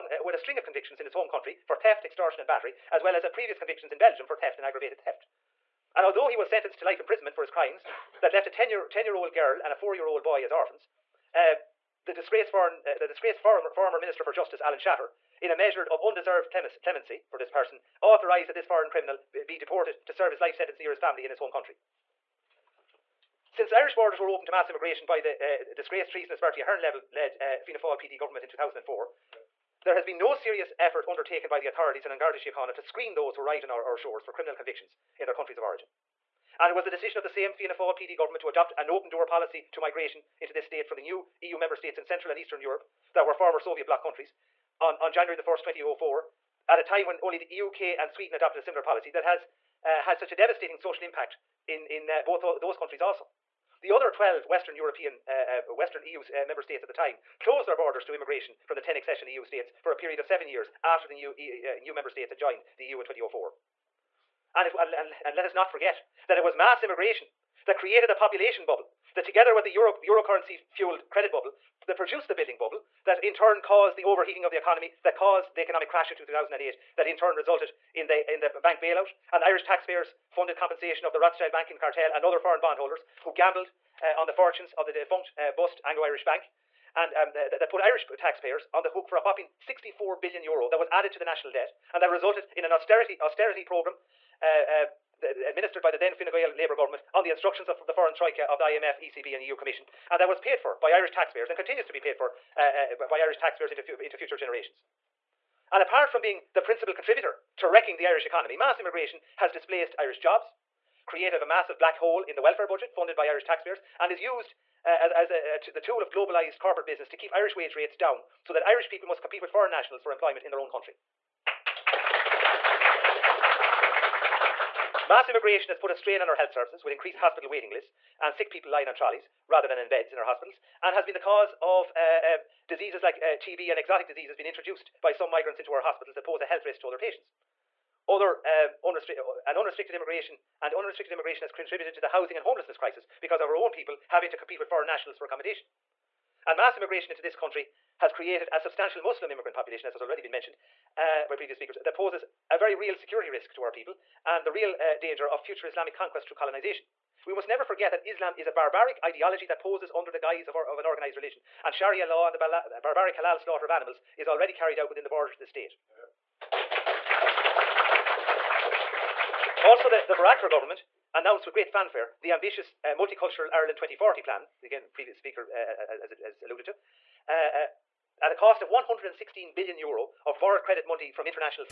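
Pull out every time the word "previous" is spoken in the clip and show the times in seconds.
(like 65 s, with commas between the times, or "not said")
3 s, 151 s, 174 s.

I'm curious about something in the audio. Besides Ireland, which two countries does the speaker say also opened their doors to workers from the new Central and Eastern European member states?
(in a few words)
UK and Sweden.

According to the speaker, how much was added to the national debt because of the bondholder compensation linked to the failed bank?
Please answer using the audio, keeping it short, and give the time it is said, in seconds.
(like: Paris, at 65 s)
64 billion euro, at 89 s.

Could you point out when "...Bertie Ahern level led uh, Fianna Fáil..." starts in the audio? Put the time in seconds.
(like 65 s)
26 s.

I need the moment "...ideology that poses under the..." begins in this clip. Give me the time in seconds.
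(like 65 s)
159 s.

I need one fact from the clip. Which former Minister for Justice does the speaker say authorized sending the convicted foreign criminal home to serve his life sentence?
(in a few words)
Alan Shatter.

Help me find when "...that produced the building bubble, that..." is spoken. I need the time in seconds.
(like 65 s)
71 s.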